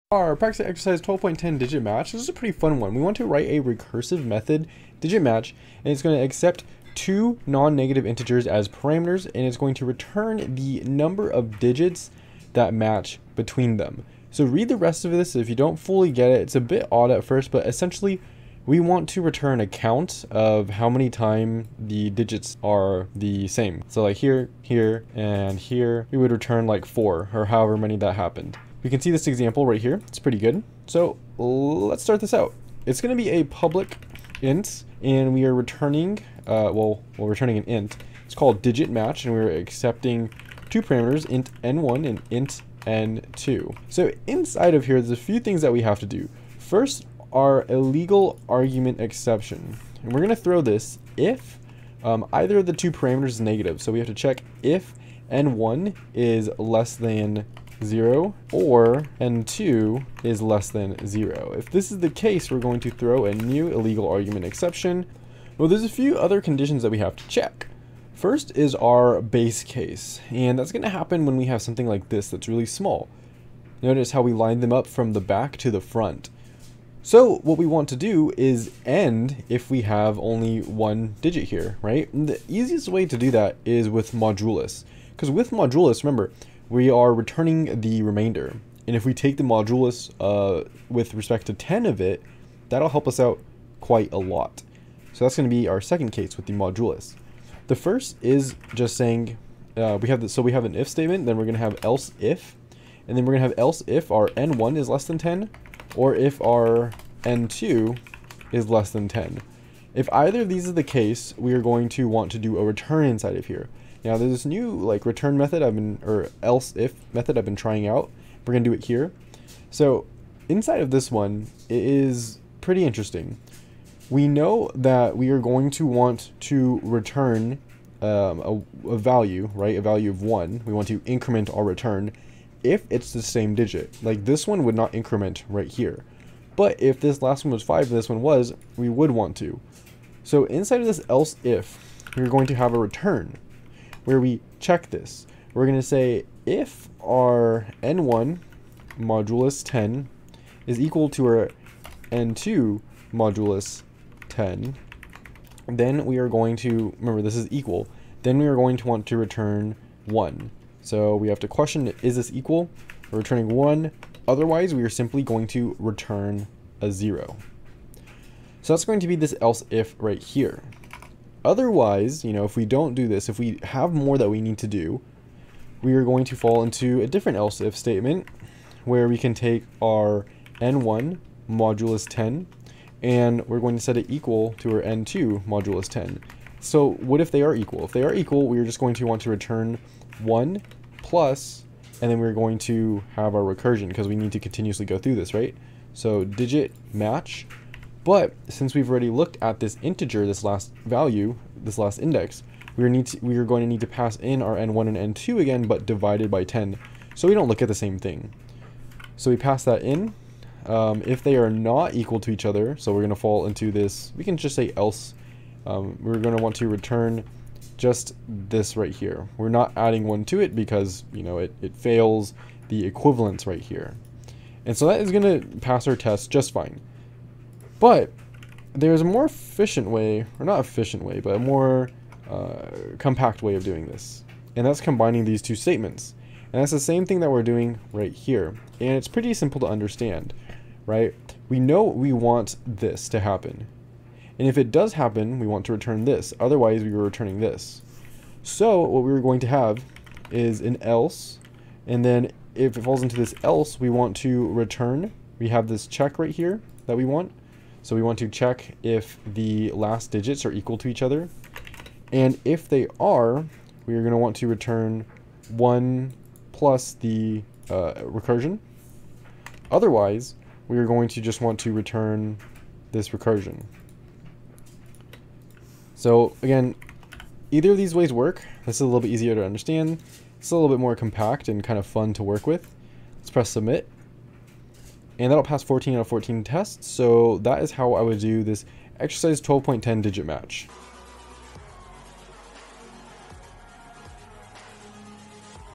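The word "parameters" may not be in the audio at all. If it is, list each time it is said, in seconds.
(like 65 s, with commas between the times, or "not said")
8 s, 40 s, 52 s.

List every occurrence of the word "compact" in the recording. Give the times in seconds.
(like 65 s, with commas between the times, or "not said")
232 s, 280 s.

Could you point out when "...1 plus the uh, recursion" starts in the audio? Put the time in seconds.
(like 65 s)
265 s.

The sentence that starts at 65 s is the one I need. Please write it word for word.
Well, there's a few other conditions that we have to check.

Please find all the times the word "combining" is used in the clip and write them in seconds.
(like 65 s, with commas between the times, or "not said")
234 s.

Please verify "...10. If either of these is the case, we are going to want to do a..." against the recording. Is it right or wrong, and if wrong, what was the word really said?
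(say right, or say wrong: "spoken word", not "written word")
right.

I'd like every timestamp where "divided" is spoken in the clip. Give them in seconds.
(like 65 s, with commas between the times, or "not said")
205 s.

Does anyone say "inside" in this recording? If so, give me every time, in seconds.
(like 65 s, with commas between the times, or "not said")
44 s, 113 s, 120 s, 140 s.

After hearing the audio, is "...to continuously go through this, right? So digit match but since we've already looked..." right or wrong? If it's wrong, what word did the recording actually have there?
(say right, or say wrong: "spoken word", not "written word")
right.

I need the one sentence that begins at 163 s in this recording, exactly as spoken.
We're returning 1, otherwise we are simply going to return a 0.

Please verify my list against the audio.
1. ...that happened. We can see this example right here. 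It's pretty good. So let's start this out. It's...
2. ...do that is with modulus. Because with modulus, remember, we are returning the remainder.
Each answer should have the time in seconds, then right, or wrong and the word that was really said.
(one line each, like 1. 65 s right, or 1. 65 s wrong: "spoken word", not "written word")
1. 27 s right
2. 83 s right.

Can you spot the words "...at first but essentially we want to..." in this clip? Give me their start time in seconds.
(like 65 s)
17 s.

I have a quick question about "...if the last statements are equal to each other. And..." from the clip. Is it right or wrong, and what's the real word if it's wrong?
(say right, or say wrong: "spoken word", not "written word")
wrong: "digits", not "statements".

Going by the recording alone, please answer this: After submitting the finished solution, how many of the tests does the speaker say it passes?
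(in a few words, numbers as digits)
14 out of 14.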